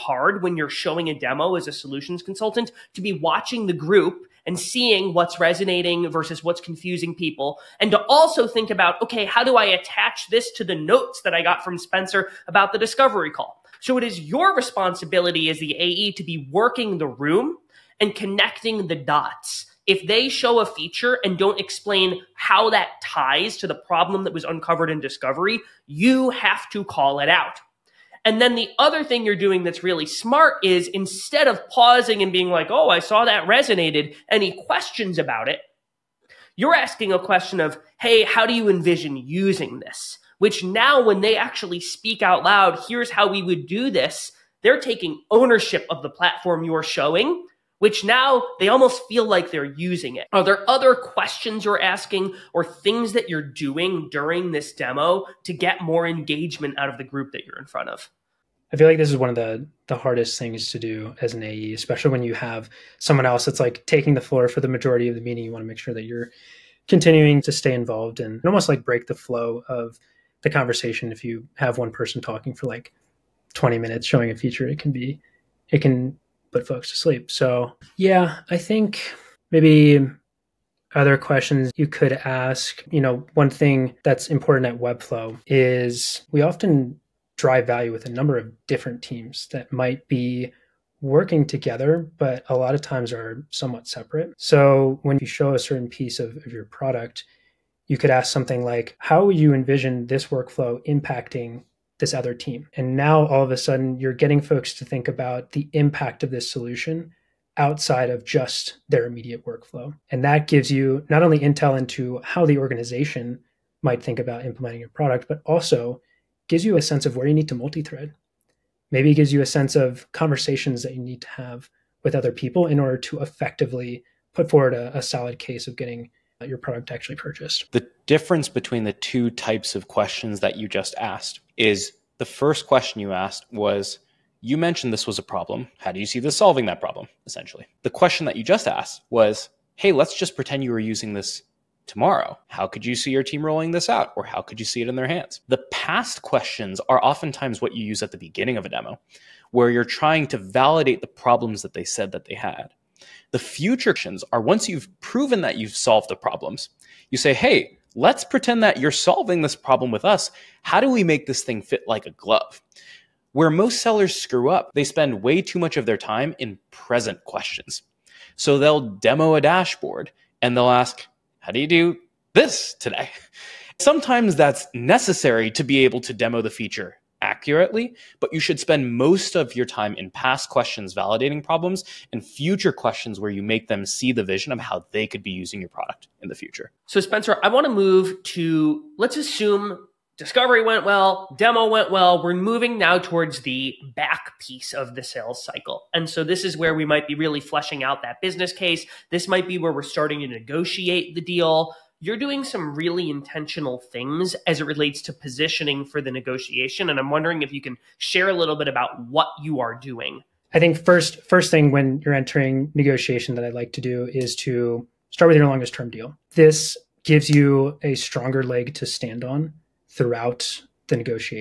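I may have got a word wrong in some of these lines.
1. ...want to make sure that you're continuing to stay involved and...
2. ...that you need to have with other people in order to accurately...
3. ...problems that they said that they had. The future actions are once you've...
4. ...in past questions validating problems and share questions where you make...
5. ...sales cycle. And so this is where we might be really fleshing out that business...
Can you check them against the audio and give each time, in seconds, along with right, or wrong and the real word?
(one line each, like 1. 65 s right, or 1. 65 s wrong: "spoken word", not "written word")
1. 65 s right
2. 120 s wrong: "effectively", not "accurately"
3. 151 s right
4. 179 s wrong: "future", not "share"
5. 195 s right.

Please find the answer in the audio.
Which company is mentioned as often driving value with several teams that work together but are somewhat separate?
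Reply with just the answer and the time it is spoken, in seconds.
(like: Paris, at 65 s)
Webflow, at 84 s.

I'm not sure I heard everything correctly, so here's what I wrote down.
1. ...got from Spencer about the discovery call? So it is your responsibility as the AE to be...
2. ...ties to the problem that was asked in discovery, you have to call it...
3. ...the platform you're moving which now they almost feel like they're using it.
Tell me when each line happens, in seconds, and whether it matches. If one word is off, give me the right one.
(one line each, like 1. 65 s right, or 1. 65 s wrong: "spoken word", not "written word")
1. 11 s right
2. 23 s wrong: "uncovered", not "asked"
3. 46 s wrong: "showing", not "moving".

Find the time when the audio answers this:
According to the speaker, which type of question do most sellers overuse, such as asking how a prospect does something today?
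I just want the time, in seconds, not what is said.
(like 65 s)
166 s.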